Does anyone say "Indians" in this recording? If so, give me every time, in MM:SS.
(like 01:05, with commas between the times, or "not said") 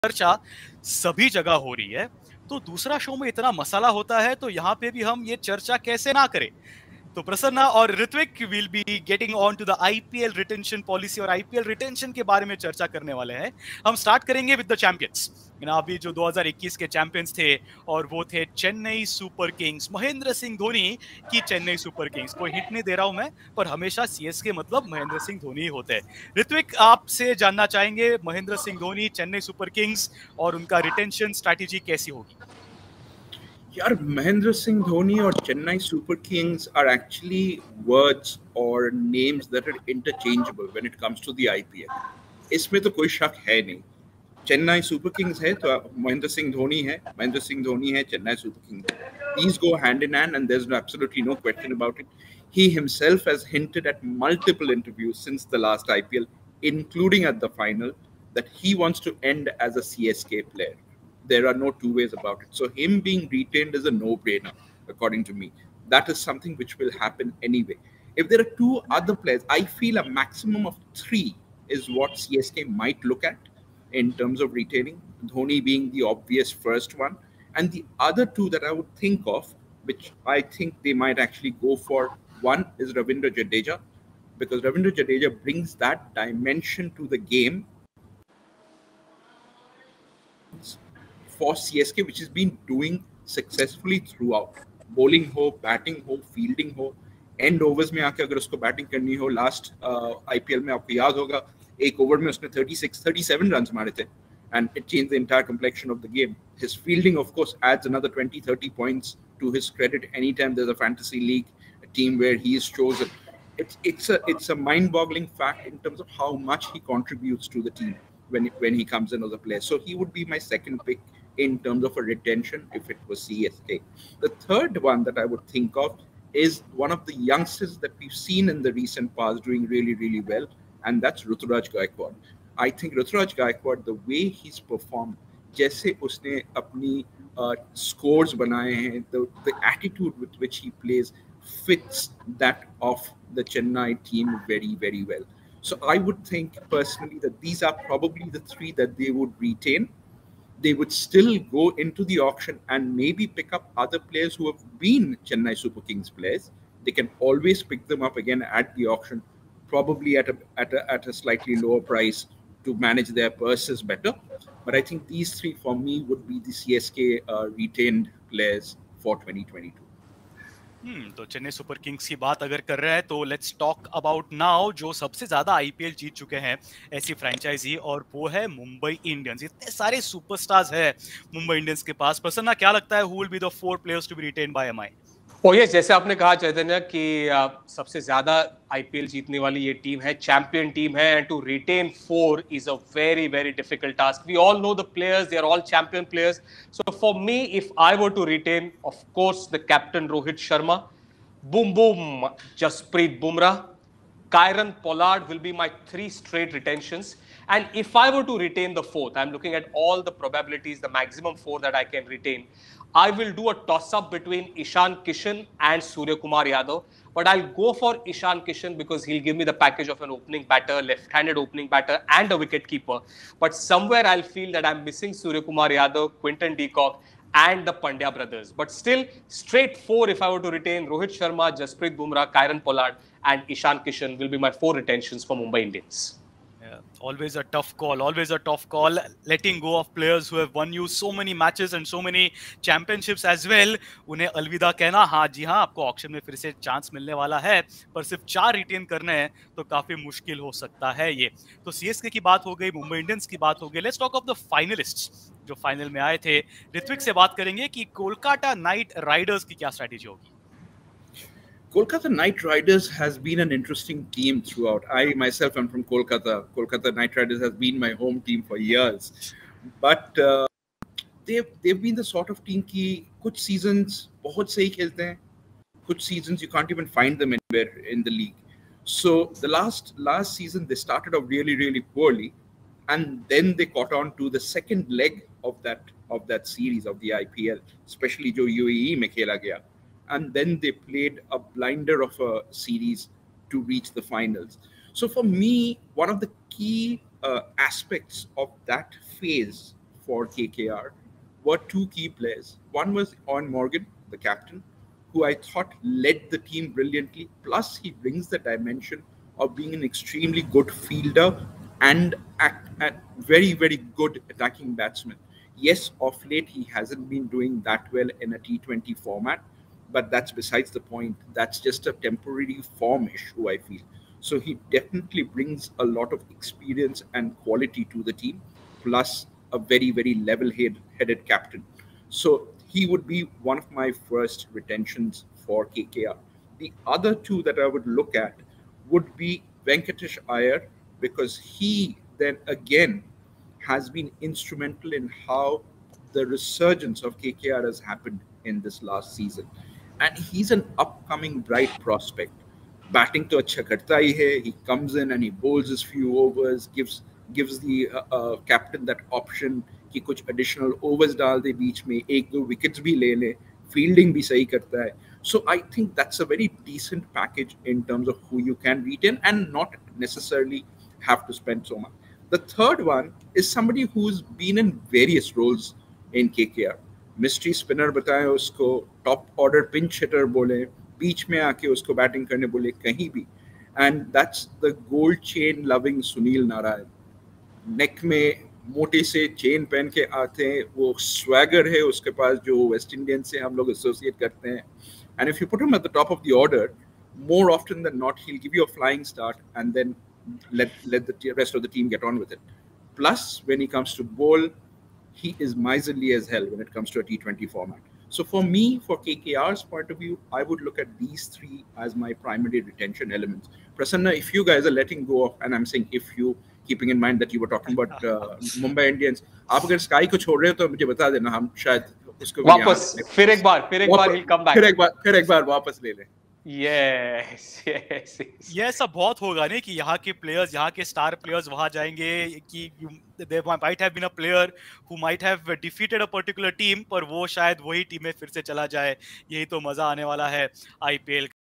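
03:55, 06:58.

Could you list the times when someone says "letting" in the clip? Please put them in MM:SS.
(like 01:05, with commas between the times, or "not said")
03:59, 06:54.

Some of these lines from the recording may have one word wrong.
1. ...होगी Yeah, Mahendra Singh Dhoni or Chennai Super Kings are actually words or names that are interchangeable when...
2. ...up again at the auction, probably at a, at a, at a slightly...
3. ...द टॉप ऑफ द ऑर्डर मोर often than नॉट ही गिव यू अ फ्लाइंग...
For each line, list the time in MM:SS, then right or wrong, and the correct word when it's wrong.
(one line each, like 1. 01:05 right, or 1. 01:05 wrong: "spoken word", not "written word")
1. 00:32 right
2. 02:38 right
3. 06:35 right.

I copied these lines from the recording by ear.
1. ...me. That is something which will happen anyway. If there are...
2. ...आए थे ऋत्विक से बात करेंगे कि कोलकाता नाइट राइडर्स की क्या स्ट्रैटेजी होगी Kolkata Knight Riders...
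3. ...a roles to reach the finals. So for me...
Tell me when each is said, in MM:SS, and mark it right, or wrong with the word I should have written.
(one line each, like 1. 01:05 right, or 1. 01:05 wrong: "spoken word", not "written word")
1. 01:05 right
2. 04:16 right
3. 04:52 wrong: "series", not "roles".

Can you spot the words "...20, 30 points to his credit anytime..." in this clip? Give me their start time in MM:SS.
01:48.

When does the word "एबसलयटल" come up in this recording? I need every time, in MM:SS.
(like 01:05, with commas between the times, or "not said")
00:50.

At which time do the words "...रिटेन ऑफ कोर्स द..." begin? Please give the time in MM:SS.
03:18.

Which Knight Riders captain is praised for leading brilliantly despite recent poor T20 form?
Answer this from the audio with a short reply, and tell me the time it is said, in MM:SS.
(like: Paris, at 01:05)
Eoin Morgan, at 05:03.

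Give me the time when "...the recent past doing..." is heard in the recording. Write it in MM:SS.
02:08.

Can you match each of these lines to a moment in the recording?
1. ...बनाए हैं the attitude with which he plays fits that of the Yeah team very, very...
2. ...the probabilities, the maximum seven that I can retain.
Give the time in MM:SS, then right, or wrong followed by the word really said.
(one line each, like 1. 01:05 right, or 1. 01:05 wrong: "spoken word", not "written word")
1. 02:18 wrong: "Chennai", not "Yeah"
2. 03:30 wrong: "four", not "seven".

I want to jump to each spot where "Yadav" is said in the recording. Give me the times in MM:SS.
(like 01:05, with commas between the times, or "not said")
03:36, 03:45.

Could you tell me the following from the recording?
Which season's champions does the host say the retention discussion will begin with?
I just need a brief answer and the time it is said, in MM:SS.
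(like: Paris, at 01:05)
2021, at 00:16.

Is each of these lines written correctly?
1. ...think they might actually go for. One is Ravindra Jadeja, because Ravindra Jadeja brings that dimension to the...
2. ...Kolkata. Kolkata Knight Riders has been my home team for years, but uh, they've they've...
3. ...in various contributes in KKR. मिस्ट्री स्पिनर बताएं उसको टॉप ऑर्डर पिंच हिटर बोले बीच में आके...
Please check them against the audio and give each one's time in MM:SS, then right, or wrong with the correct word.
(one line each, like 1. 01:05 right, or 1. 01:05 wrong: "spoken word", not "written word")
1. 01:20 right
2. 04:25 right
3. 06:14 wrong: "roles", not "contributes".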